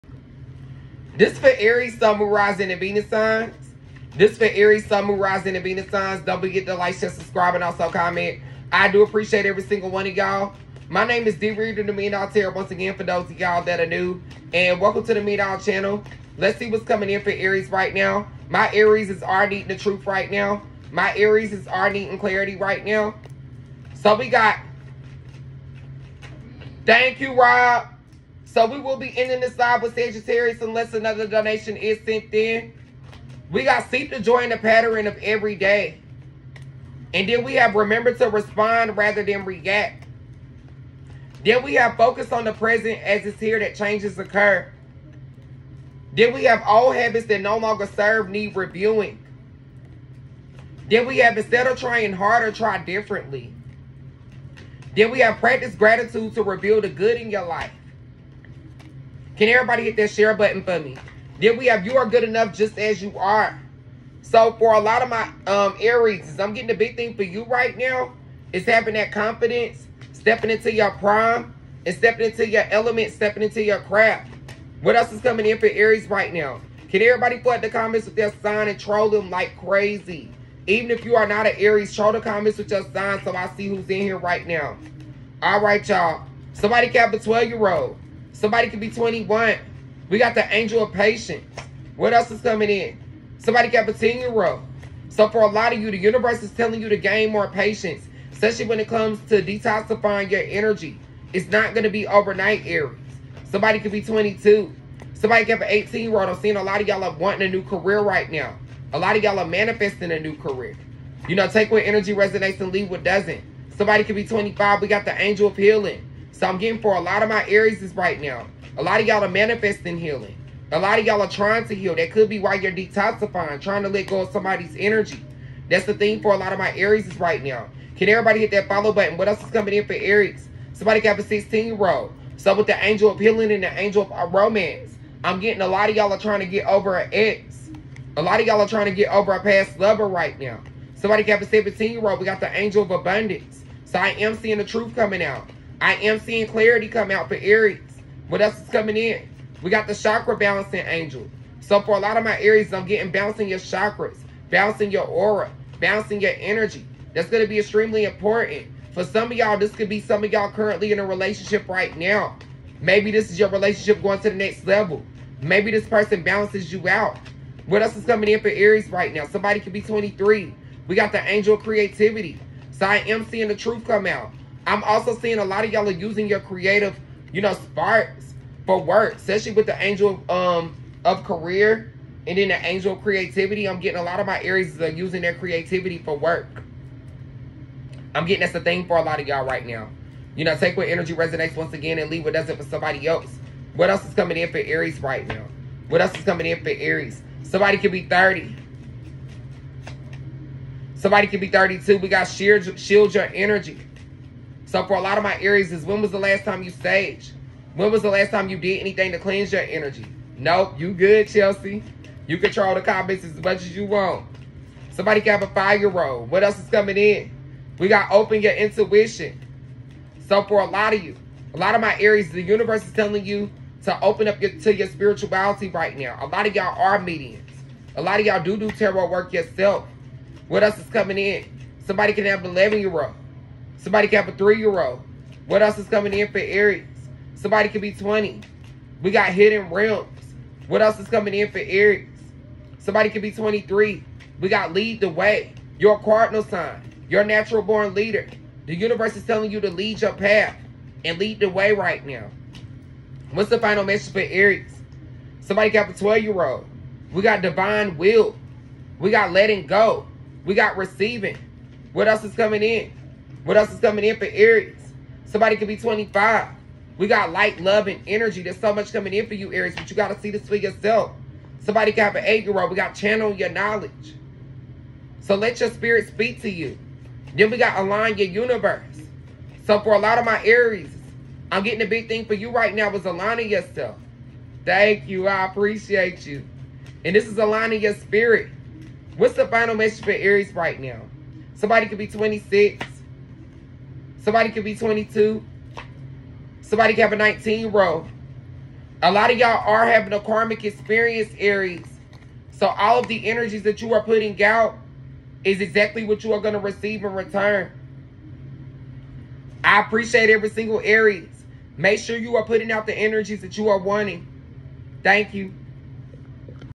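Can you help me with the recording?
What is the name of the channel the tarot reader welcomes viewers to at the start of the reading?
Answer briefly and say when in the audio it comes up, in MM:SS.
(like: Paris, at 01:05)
Mean All, at 00:15.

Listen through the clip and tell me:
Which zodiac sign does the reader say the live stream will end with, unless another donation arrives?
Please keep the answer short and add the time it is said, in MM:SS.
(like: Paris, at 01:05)
Sagittarius, at 00:29.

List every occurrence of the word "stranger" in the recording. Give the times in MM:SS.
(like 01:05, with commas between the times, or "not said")
not said.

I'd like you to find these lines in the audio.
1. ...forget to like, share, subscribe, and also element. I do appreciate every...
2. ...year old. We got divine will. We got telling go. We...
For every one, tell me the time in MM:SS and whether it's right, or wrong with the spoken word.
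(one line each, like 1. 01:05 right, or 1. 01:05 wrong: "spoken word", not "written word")
1. 00:06 wrong: "comment", not "element"
2. 04:16 wrong: "letting", not "telling".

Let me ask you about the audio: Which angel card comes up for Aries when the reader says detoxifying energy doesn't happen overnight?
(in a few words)
angel of patience.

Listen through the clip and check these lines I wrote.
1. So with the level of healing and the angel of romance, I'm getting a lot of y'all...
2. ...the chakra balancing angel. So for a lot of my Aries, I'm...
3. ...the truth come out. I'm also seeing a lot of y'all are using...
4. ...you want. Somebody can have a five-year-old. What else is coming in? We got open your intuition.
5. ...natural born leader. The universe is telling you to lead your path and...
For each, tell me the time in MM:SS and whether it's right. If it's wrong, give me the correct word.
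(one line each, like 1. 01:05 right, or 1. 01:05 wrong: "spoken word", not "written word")
1. 02:12 wrong: "angel", not "level"
2. 02:29 right
3. 02:53 right
4. 03:33 right
5. 04:07 right.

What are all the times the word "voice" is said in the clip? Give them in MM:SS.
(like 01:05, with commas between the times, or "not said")
not said.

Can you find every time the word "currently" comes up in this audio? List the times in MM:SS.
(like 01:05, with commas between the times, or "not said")
02:40.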